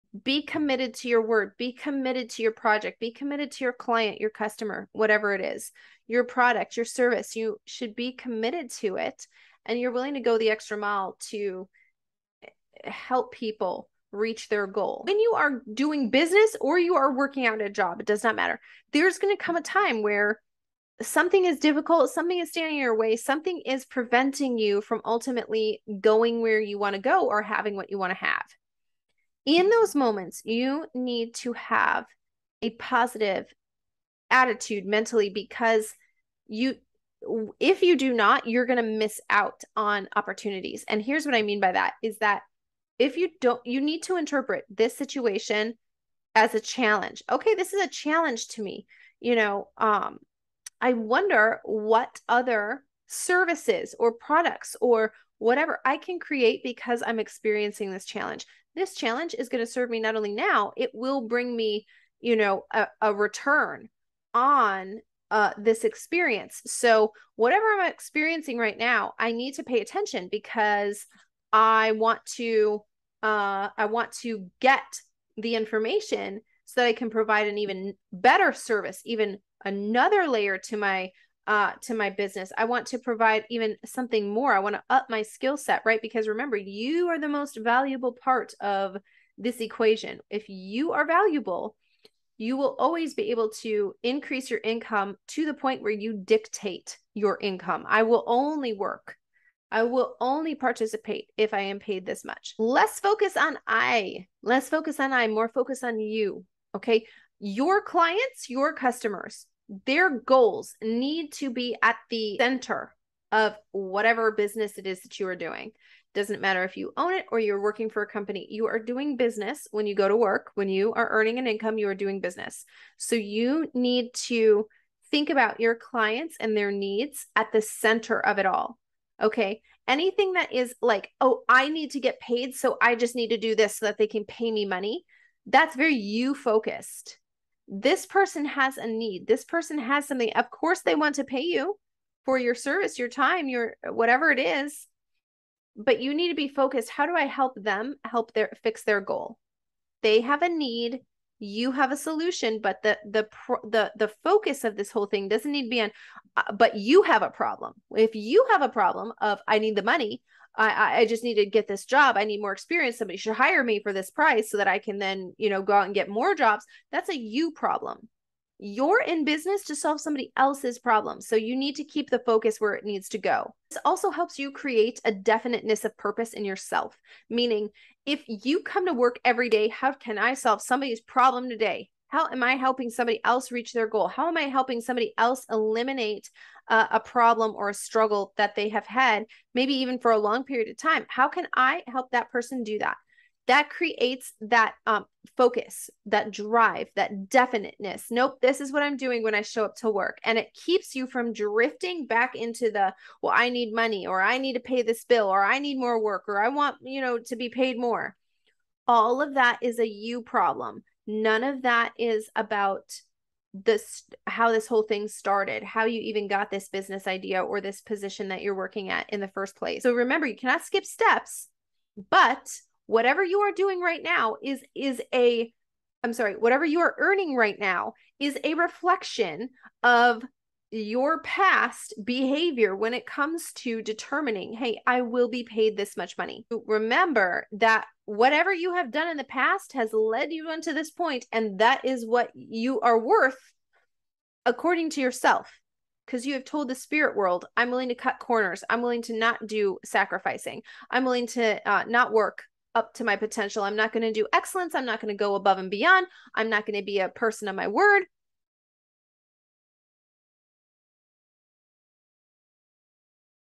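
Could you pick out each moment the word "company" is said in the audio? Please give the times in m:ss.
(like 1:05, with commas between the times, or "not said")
1:58.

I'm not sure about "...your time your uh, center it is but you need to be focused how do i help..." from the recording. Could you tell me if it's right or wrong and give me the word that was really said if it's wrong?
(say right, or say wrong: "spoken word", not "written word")
wrong: "whatever", not "center".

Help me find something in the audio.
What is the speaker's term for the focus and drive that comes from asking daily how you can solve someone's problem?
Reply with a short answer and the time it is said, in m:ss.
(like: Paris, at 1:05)
definiteness of purpose, at 2:55.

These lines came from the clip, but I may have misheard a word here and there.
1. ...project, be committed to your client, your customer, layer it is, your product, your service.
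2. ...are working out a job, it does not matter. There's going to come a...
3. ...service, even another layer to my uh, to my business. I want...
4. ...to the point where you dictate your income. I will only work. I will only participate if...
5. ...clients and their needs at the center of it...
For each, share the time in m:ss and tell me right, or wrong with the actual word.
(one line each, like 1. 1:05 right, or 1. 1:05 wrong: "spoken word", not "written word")
1. 0:02 wrong: "whatever", not "layer"
2. 0:16 right
3. 1:18 right
4. 1:35 right
5. 2:05 right.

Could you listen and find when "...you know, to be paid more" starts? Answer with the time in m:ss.
3:26.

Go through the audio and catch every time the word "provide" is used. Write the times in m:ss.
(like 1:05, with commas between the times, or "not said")
1:17, 1:22.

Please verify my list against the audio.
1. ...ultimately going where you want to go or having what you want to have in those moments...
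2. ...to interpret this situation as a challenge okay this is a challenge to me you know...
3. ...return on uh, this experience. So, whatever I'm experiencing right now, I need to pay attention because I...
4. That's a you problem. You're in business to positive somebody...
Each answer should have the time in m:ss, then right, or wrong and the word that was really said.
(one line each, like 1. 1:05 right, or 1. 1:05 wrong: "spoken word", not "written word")
1. 0:25 right
2. 0:44 right
3. 1:03 right
4. 2:46 wrong: "solve", not "positive".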